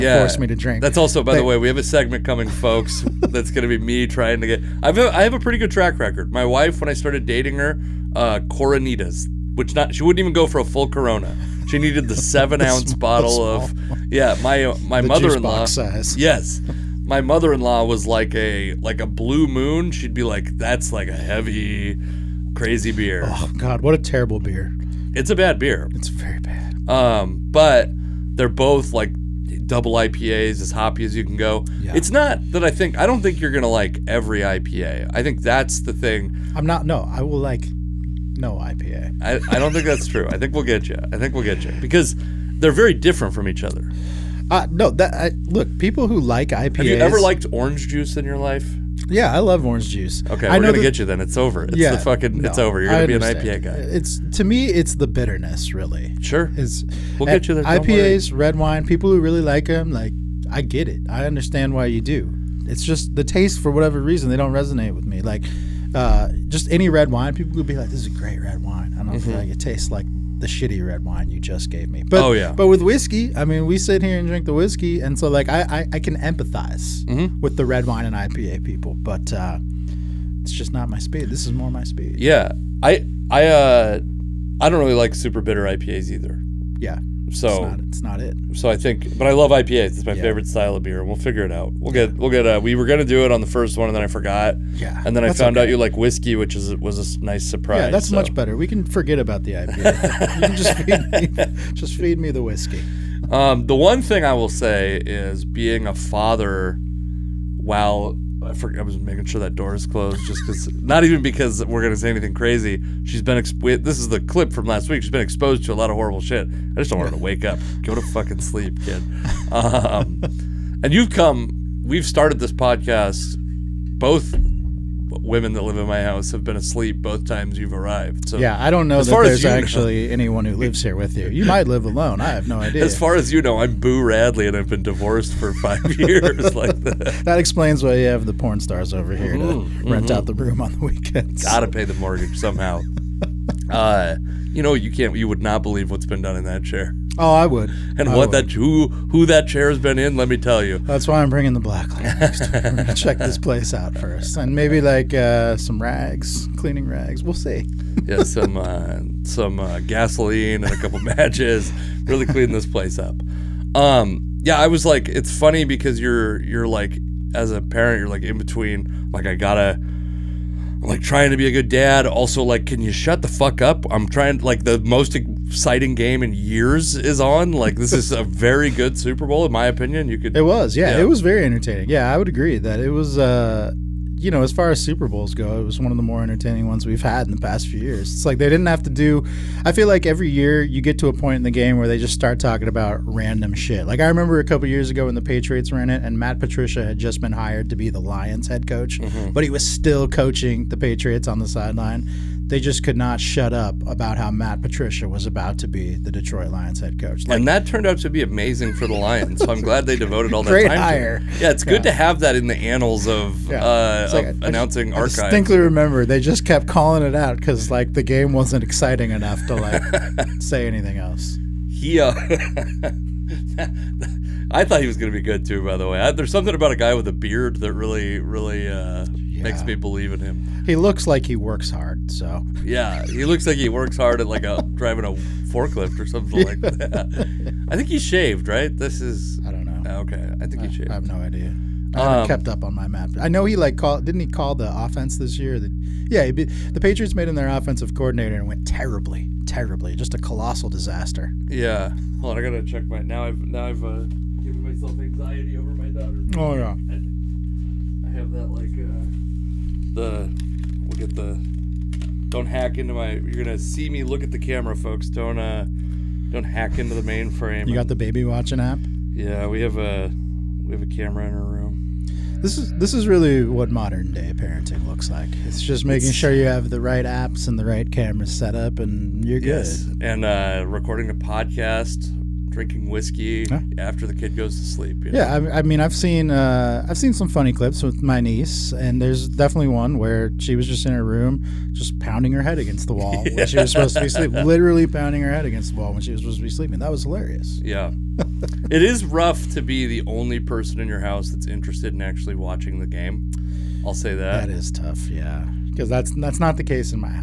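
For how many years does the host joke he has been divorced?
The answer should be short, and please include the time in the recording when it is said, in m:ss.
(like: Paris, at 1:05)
5, at 2:15.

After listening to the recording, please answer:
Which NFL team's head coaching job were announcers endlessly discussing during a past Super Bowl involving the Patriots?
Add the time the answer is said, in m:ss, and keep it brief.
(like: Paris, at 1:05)
Detroit Lions, at 3:26.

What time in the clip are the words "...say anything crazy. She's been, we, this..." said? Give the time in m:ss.
1:51.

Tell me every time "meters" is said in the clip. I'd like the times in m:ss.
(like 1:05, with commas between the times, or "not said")
not said.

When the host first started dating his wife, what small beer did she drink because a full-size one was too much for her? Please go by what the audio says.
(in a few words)
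Coronitas.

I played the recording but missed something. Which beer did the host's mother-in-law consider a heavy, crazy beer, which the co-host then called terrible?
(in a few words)
Blue Moon.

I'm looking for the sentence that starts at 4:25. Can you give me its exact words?
Don't uh, don't hack into the mainframe.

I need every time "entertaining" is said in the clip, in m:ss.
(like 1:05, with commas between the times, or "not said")
3:01, 3:06.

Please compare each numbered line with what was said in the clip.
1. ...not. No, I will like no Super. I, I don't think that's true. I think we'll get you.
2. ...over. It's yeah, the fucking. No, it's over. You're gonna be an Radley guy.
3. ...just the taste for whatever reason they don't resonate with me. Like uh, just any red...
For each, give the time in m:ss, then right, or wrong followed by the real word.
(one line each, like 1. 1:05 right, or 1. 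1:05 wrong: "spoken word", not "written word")
1. 0:36 wrong: "IPA", not "Super"
2. 0:51 wrong: "IPA", not "Radley"
3. 1:02 right.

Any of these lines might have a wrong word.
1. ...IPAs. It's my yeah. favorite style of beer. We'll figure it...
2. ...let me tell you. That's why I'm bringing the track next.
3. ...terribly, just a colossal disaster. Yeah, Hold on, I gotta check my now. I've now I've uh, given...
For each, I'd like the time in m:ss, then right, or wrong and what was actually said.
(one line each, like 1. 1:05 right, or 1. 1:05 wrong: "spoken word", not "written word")
1. 1:29 right
2. 2:30 wrong: "black", not "track"
3. 4:09 right.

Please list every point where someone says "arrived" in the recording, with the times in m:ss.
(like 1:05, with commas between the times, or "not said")
2:07.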